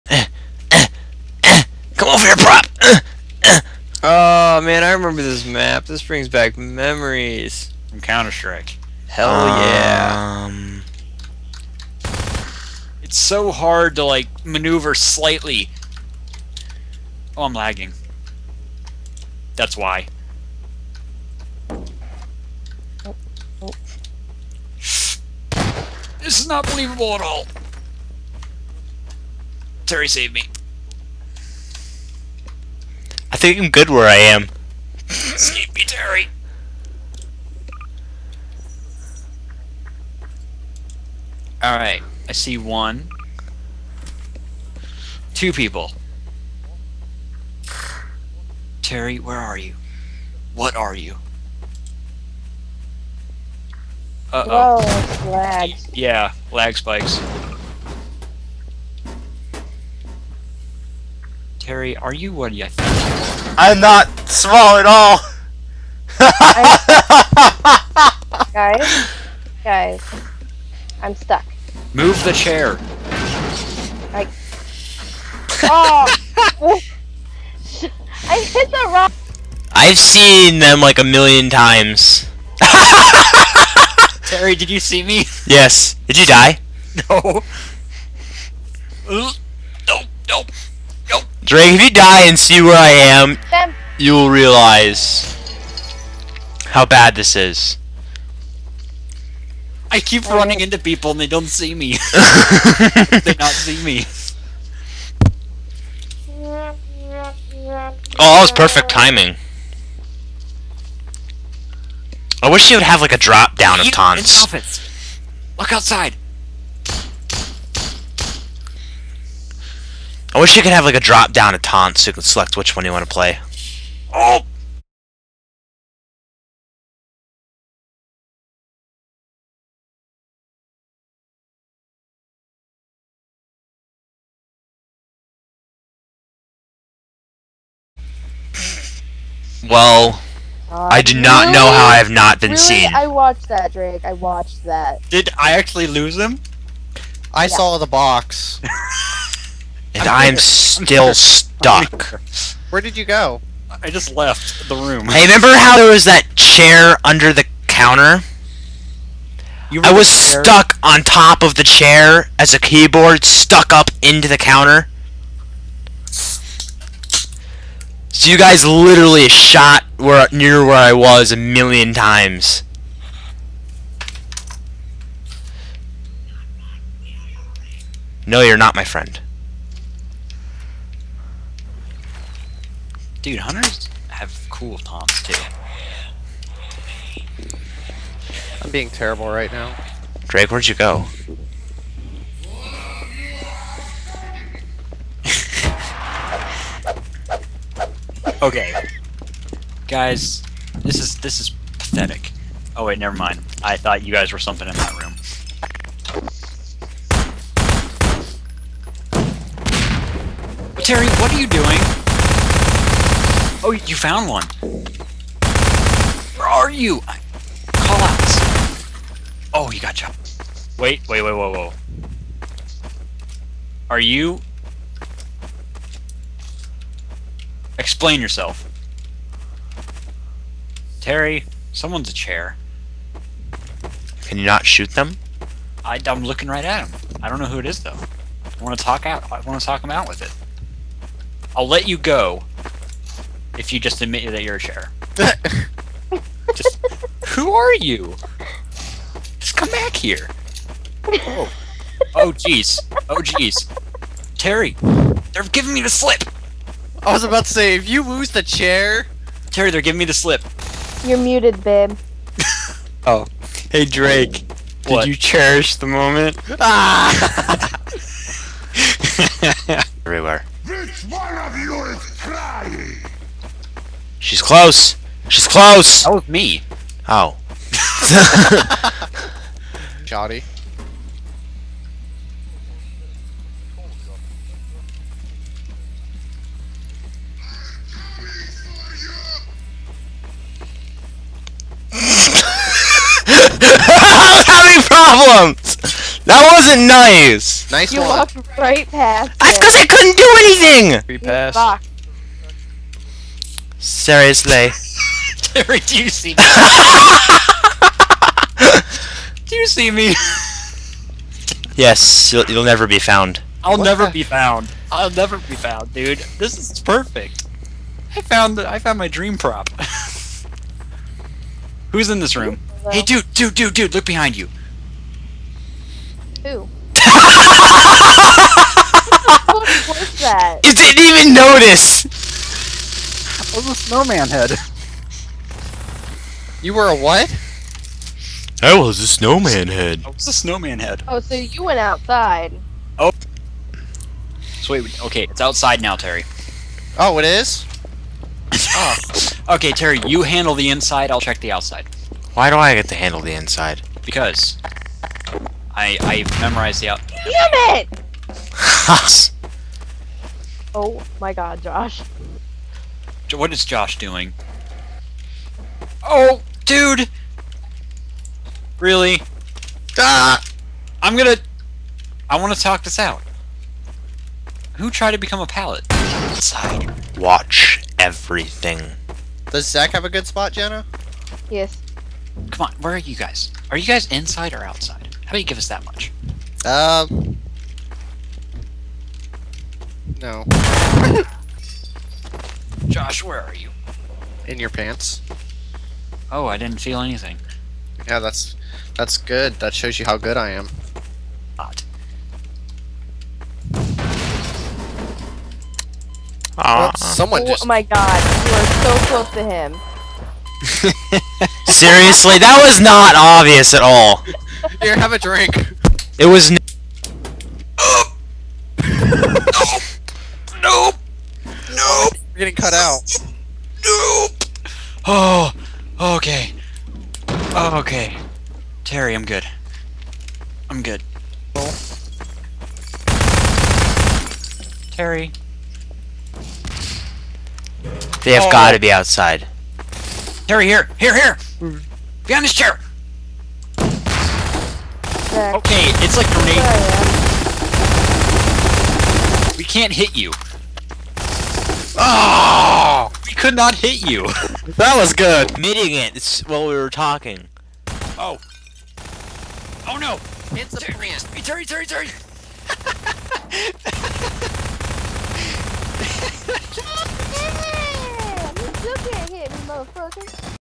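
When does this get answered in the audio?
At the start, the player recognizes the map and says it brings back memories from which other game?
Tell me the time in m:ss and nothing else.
0:07.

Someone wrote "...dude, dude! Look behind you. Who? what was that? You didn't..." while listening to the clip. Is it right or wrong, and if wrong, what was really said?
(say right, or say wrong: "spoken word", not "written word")
right.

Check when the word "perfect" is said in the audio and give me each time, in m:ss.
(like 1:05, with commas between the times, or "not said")
1:48, 5:16.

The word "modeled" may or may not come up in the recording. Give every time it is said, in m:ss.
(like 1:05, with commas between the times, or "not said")
not said.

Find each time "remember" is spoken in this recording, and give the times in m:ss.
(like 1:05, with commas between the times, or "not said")
0:04, 2:35.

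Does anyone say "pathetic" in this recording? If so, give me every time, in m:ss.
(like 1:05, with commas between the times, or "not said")
3:21.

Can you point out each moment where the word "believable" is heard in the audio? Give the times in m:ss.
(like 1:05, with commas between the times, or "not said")
0:26.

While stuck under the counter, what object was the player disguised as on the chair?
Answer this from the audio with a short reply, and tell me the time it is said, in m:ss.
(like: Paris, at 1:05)
keyboard, at 2:42.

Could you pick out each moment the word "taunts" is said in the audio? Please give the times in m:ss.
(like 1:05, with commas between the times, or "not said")
1:53, 2:01, 3:04.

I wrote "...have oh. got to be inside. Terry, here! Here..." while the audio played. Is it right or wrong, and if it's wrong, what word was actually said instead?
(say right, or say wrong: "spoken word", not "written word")
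wrong: "outside", not "inside".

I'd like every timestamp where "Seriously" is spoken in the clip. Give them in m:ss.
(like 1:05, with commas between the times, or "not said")
5:03, 6:51.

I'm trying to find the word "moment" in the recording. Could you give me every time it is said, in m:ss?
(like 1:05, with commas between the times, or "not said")
4:25.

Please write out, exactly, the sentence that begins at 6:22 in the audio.
Come on, where are you guys?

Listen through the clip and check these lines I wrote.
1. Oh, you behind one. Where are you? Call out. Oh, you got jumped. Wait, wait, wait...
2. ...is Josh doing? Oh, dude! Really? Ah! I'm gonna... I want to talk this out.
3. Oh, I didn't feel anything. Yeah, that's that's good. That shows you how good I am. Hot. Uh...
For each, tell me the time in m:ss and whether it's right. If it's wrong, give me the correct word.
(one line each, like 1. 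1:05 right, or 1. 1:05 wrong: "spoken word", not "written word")
1. 3:33 wrong: "found", not "behind"
2. 6:03 right
3. 6:36 right.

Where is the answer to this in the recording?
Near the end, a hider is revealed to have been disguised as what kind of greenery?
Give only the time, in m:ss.
7:40.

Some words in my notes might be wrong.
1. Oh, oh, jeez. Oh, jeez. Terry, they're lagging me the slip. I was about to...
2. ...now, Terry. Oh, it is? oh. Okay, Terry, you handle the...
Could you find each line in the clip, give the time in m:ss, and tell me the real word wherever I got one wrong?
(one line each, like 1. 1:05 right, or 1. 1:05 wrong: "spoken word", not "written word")
1. 4:11 wrong: "giving", not "lagging"
2. 5:45 right.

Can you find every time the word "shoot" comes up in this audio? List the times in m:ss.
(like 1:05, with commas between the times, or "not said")
3:54.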